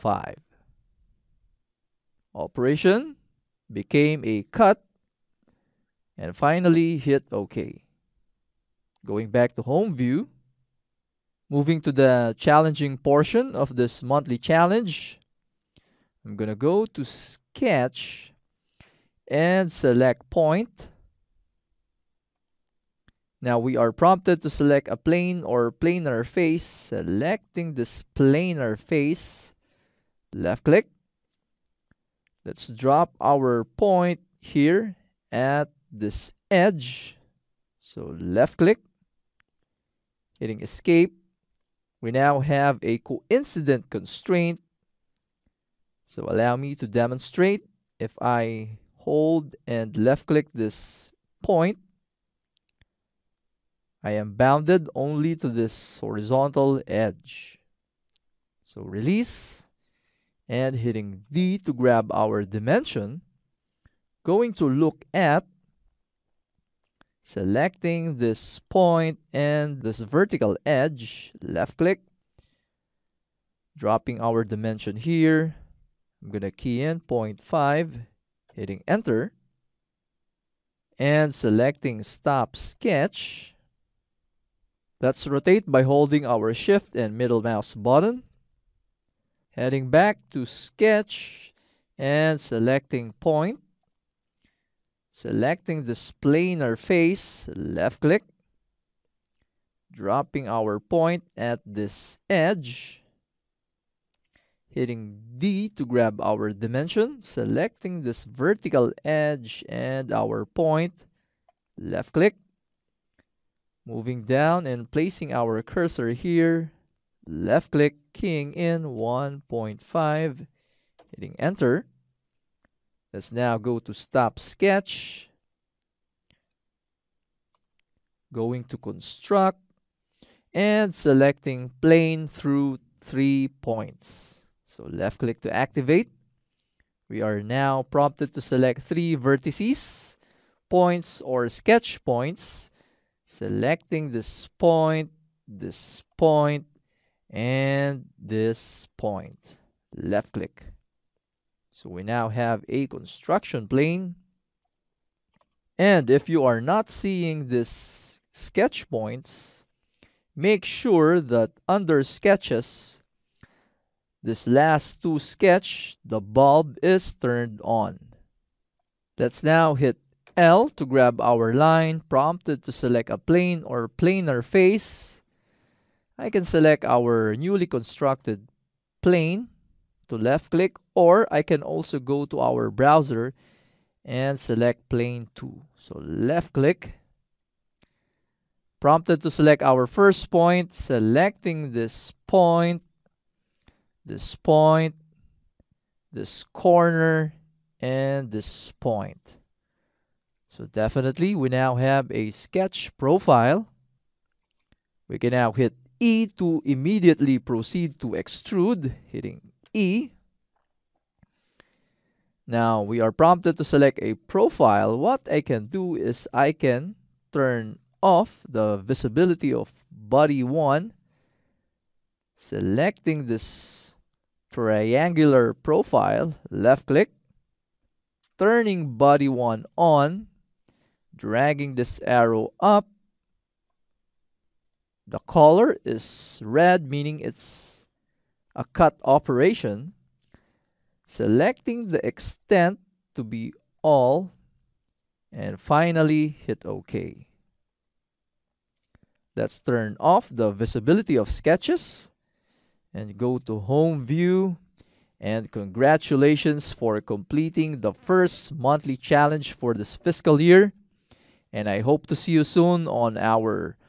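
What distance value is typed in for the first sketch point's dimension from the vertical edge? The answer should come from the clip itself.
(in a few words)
0.5.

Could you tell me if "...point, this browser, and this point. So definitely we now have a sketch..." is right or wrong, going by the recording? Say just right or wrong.
wrong.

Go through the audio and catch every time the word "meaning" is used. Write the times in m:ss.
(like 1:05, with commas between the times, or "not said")
3:56.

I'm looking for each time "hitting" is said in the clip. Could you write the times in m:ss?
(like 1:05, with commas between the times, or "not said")
0:40, 1:00, 1:18, 1:44, 2:01, 3:29.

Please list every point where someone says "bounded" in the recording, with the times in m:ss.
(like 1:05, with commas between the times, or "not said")
0:54.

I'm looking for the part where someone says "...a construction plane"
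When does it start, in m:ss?
2:32.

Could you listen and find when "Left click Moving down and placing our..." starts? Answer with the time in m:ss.
1:51.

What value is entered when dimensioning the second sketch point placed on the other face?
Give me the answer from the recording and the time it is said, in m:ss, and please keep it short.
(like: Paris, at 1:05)
1.5, at 1:58.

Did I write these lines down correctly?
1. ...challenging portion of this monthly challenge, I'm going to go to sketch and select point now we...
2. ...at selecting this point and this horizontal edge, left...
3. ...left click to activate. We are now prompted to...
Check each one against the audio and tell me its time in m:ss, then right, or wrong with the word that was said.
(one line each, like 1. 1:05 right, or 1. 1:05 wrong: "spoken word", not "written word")
1. 0:12 right
2. 1:05 wrong: "vertical", not "horizontal"
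3. 2:14 right.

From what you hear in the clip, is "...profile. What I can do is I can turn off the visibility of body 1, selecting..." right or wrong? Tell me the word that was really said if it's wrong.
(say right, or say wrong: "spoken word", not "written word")
right.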